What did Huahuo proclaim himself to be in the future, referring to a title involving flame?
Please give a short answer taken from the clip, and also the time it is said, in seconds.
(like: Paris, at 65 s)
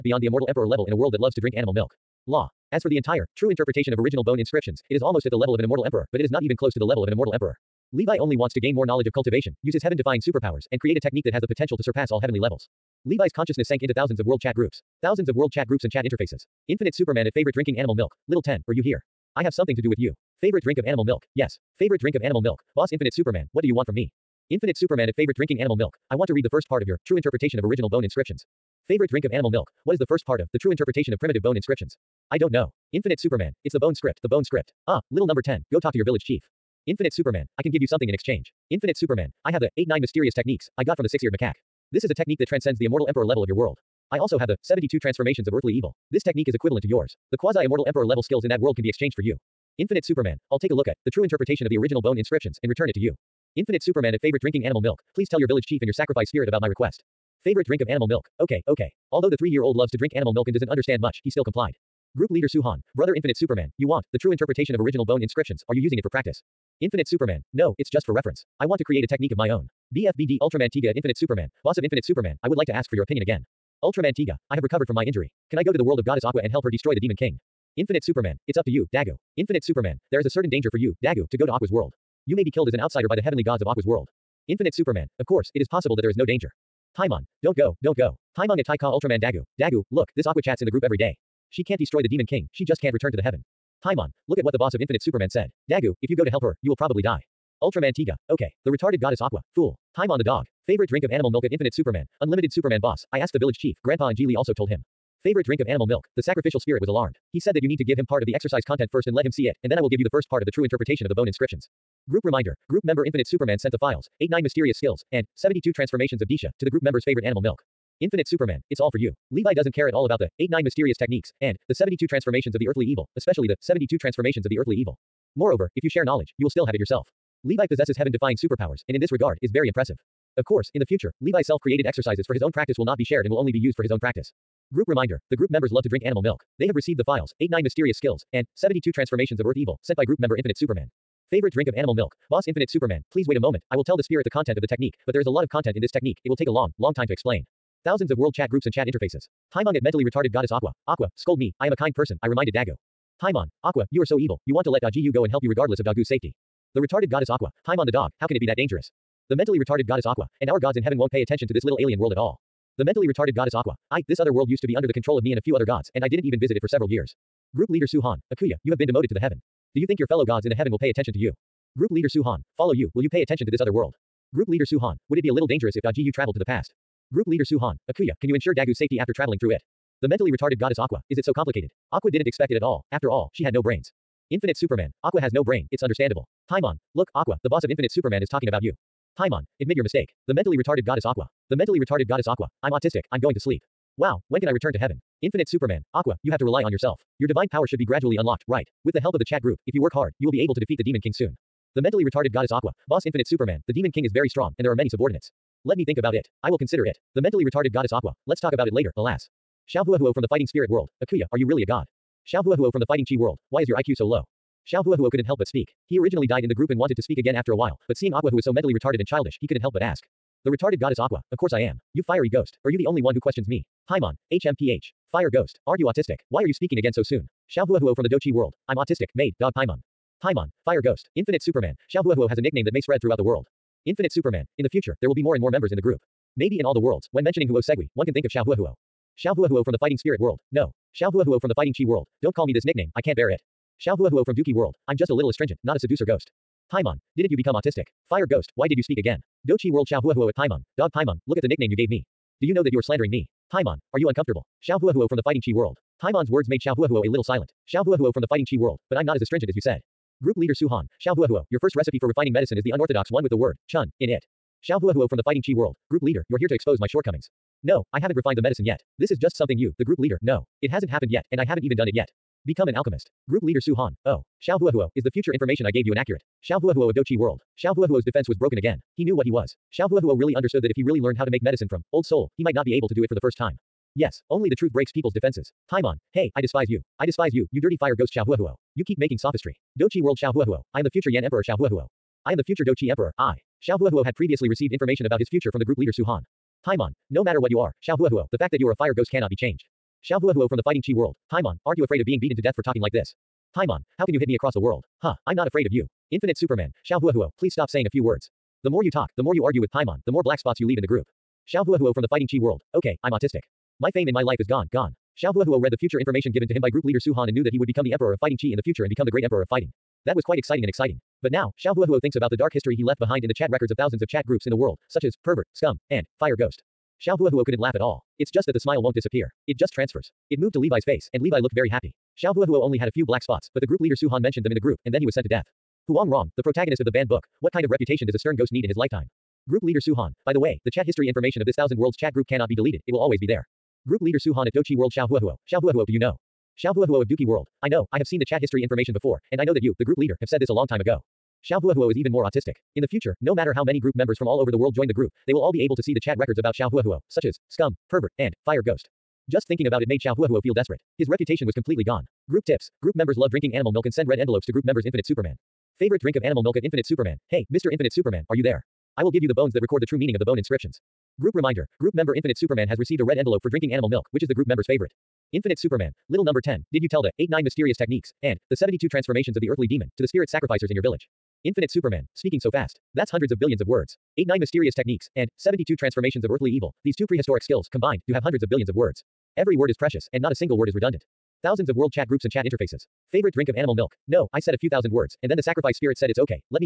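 Yan Emperor, at 290 s.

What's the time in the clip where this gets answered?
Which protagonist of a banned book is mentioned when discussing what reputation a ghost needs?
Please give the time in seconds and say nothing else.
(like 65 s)
335 s.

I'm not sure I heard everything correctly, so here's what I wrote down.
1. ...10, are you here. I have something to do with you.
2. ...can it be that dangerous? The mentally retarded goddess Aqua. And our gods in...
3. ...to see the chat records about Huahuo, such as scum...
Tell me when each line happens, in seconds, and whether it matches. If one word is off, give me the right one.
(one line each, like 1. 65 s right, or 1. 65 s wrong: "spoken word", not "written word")
1. 18 s right
2. 158 s right
3. 355 s right.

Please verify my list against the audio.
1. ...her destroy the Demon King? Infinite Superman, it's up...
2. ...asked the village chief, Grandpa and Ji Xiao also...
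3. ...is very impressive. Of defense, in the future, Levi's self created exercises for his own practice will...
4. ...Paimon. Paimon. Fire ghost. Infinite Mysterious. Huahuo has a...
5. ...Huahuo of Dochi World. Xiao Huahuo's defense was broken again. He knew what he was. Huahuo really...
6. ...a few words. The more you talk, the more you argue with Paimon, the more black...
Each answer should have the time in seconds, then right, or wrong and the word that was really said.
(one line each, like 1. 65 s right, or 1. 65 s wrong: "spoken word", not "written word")
1. 76 s right
2. 103 s wrong: "Lee", not "Xiao"
3. 129 s wrong: "course", not "defense"
4. 229 s wrong: "Superman", not "Mysterious"
5. 276 s right
6. 307 s right.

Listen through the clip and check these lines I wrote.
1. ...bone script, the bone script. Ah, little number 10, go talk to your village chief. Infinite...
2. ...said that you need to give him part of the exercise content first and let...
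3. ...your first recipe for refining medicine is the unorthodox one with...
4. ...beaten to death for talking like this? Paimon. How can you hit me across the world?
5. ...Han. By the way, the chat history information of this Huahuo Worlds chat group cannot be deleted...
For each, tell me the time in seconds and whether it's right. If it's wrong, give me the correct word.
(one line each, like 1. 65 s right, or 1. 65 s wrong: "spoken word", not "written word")
1. 33 s right
2. 107 s right
3. 261 s right
4. 302 s right
5. 339 s wrong: "Thousand", not "Huahuo".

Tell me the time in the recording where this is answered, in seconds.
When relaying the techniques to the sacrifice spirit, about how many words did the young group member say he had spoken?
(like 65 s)
394 s.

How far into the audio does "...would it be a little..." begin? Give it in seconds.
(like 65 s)
175 s.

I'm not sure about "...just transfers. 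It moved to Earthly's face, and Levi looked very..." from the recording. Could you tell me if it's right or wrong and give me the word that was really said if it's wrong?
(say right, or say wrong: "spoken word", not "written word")
wrong: "Levi", not "Earthly".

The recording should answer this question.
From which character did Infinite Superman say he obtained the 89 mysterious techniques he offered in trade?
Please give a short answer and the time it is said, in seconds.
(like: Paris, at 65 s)
Six-eared macaque, at 41 s.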